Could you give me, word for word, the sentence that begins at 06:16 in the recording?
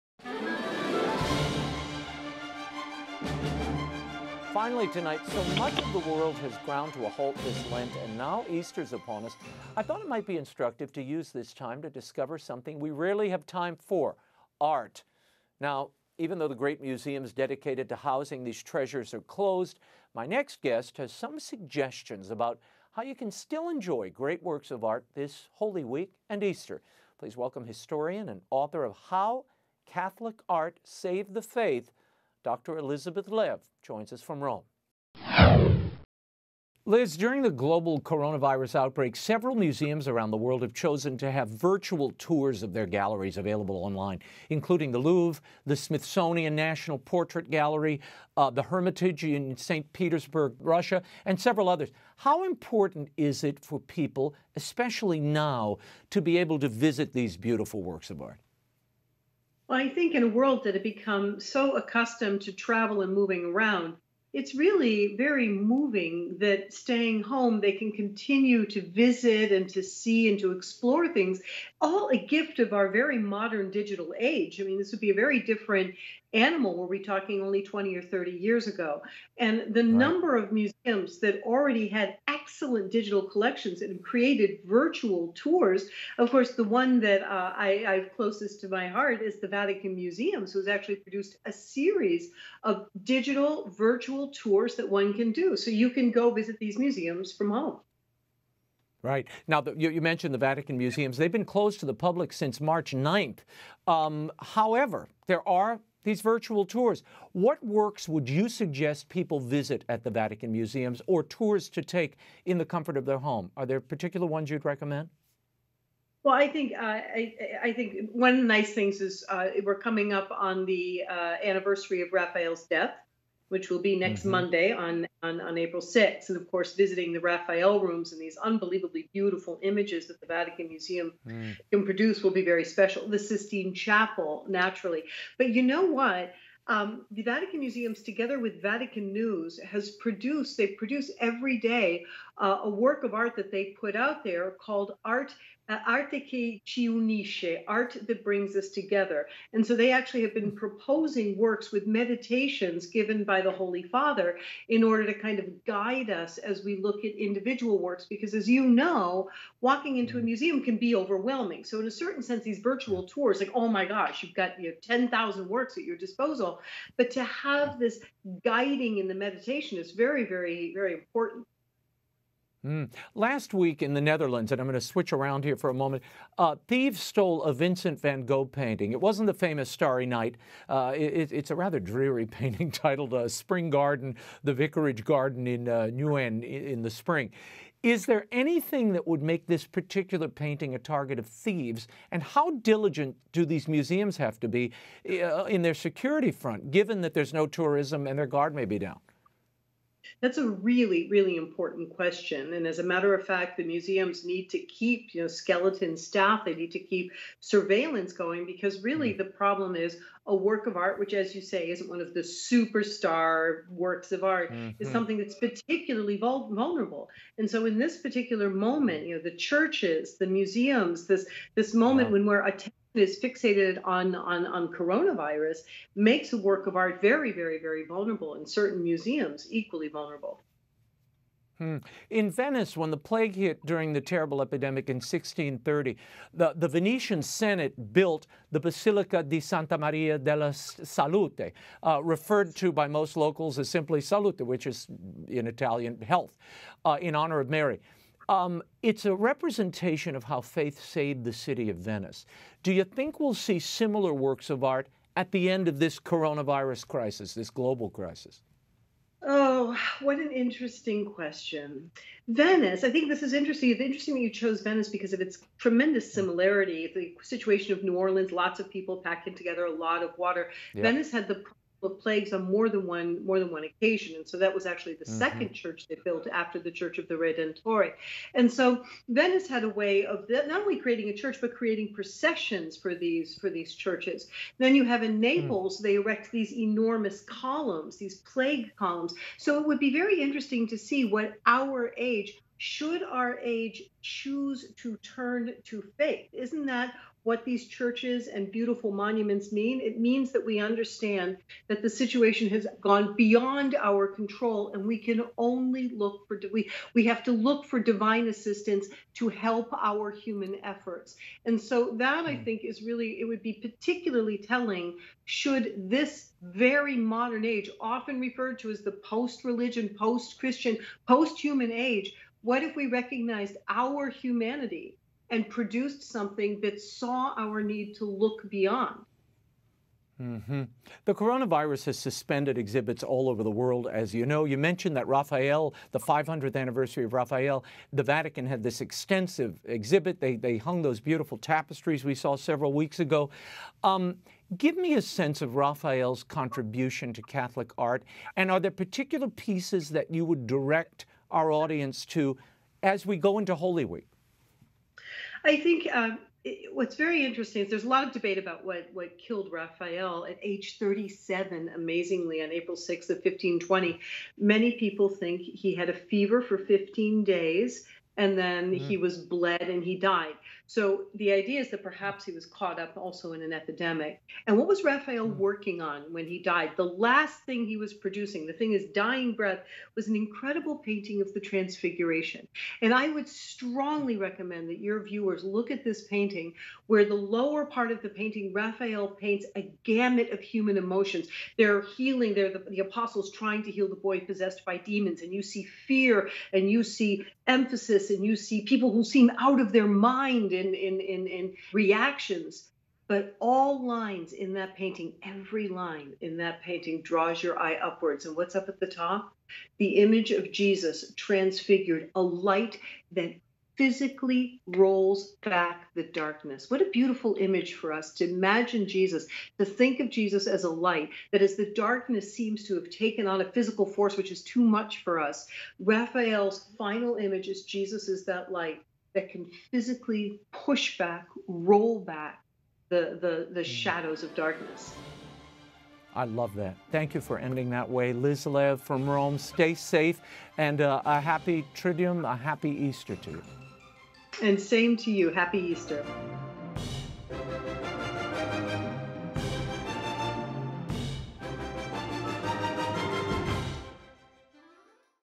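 The last thing he was producing, the thing is dying breath, was an incredible painting of the Transfiguration.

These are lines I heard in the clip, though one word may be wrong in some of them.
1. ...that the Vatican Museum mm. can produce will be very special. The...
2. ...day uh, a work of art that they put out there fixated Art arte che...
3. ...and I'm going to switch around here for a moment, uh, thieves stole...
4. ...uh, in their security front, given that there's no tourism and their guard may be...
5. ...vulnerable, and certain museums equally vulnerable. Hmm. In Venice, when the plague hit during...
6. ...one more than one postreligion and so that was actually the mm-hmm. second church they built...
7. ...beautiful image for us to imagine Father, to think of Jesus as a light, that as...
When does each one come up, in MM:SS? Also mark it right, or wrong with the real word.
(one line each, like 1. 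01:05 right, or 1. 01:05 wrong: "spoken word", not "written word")
1. 02:10 right
2. 02:21 wrong: "called", not "fixated"
3. 02:54 right
4. 03:15 right
5. 03:47 right
6. 04:32 wrong: "occasion", not "postreligion"
7. 06:56 wrong: "Jesus", not "Father".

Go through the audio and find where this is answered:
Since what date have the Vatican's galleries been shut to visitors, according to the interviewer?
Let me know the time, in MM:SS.
01:42.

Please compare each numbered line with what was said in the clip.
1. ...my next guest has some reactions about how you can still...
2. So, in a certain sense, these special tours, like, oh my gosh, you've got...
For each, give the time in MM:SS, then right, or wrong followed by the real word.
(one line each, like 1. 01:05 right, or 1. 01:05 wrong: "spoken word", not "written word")
1. 00:20 wrong: "suggestions", not "reactions"
2. 02:41 wrong: "virtual", not "special".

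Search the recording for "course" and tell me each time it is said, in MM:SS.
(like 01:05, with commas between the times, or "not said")
01:26, 02:06.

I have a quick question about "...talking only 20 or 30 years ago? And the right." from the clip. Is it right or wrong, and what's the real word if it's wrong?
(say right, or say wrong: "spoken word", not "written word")
right.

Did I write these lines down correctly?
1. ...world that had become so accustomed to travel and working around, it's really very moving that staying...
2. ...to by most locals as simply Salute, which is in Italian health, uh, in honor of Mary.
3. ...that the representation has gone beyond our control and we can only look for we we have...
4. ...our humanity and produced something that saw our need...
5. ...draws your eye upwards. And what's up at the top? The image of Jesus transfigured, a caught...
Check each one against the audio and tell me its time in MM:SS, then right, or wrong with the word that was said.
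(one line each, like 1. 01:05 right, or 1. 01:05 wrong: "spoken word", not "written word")
1. 01:00 wrong: "moving", not "working"
2. 04:02 right
3. 05:01 wrong: "situation", not "representation"
4. 05:23 right
5. 06:47 wrong: "light", not "caught".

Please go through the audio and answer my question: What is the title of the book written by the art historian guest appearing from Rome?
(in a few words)
How Catholic Art Saved the Faith.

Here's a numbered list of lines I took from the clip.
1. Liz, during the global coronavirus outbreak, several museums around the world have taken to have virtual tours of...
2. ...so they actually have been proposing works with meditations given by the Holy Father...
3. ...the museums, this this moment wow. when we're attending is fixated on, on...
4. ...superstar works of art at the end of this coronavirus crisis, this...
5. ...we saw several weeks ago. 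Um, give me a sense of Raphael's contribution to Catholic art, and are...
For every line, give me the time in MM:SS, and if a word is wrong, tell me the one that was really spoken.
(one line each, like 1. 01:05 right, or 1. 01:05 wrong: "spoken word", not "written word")
1. 00:36 wrong: "chosen", not "taken"
2. 02:29 right
3. 03:40 right
4. 04:13 wrong: "similar", not "superstar"
5. 05:42 right.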